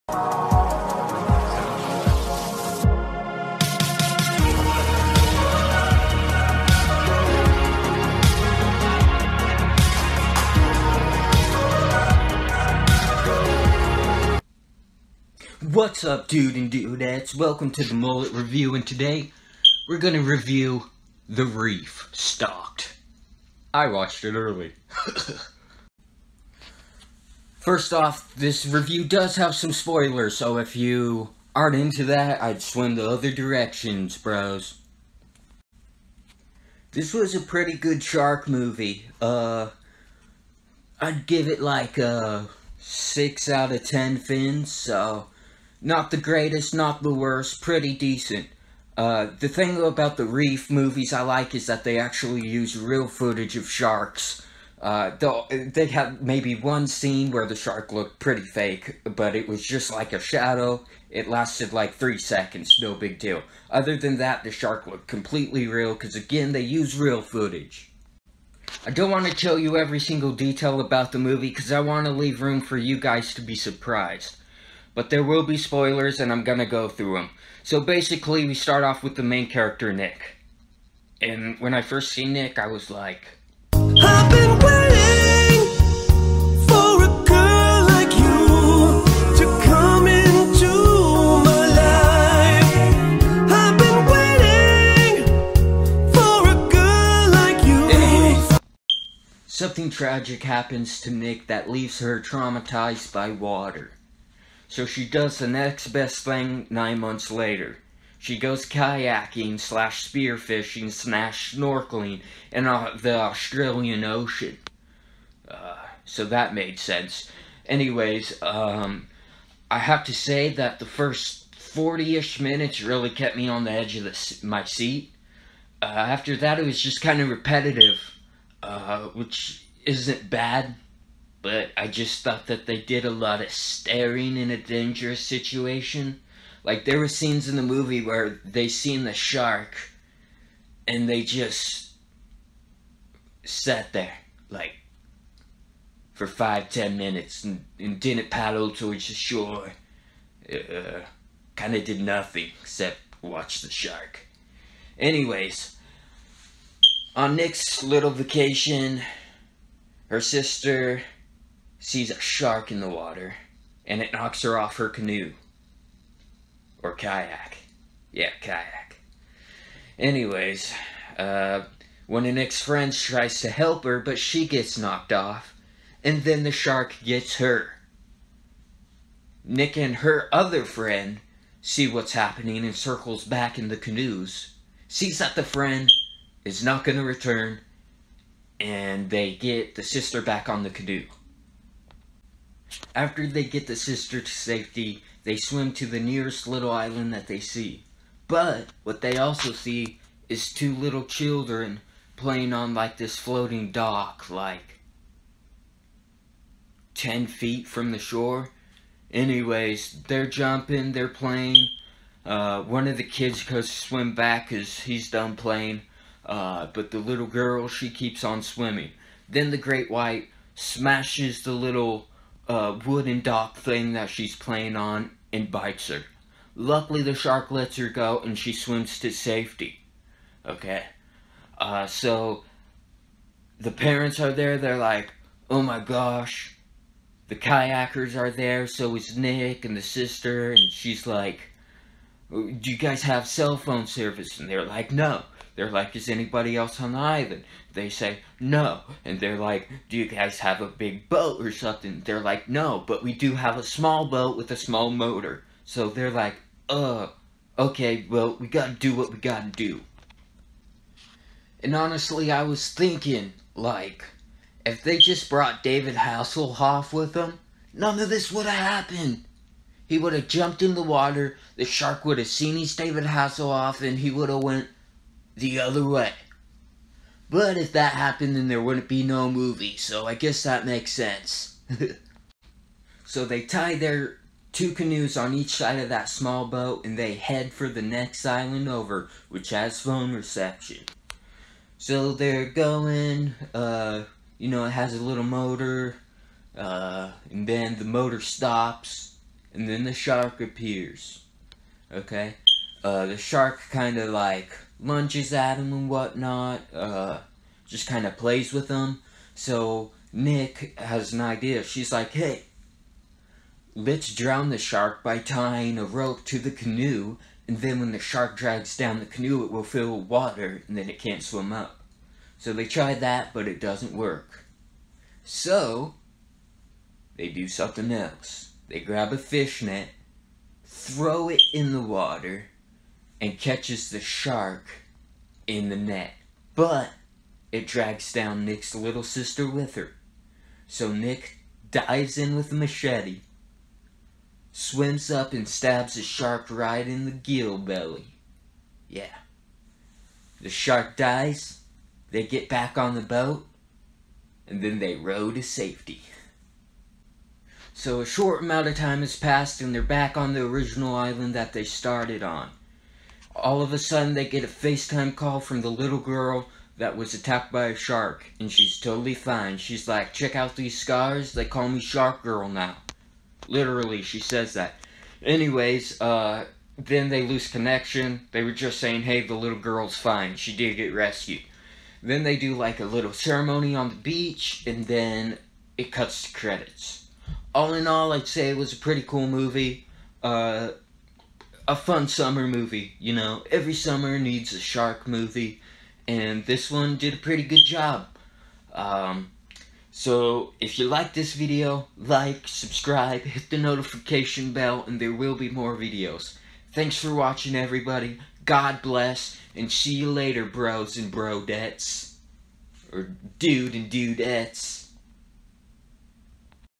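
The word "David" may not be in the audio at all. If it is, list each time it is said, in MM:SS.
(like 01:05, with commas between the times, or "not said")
04:25, 04:32.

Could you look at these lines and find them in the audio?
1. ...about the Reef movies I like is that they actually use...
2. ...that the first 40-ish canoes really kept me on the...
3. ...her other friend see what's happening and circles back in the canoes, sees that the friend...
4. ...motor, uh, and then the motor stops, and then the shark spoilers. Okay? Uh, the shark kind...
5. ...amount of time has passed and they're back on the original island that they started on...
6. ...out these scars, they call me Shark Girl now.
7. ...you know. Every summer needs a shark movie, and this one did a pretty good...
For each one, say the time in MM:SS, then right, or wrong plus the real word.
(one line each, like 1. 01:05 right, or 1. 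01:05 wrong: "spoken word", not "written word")
1. 00:49 right
2. 02:00 wrong: "minutes", not "canoes"
3. 02:59 right
4. 04:55 wrong: "appears", not "spoilers"
5. 05:58 right
6. 06:10 right
7. 06:32 right.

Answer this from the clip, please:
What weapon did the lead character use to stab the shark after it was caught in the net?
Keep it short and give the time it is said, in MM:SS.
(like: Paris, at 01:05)
machete, at 05:42.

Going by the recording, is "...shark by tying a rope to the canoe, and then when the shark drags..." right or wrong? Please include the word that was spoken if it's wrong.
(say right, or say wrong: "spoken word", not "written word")
right.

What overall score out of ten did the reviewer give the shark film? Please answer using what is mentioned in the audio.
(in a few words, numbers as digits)
6.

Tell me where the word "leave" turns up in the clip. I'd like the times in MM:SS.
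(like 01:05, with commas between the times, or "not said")
01:12, 01:41.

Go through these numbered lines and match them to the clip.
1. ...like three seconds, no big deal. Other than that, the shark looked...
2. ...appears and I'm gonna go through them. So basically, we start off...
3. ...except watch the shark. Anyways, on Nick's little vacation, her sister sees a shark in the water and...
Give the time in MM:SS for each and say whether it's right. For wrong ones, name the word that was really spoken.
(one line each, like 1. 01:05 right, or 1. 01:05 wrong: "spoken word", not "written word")
1. 01:01 right
2. 01:15 wrong: "spoilers", not "appears"
3. 02:32 right.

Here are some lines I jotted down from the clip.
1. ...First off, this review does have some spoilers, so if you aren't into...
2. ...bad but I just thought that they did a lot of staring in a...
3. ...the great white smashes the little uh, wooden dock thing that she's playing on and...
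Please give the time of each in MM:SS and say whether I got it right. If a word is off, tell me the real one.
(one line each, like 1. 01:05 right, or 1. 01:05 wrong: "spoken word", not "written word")
1. 00:27 right
2. 02:10 right
3. 03:39 right.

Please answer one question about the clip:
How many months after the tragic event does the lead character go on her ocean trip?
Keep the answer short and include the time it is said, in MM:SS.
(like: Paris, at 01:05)
9, at 01:46.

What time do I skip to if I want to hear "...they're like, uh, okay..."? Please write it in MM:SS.
04:15.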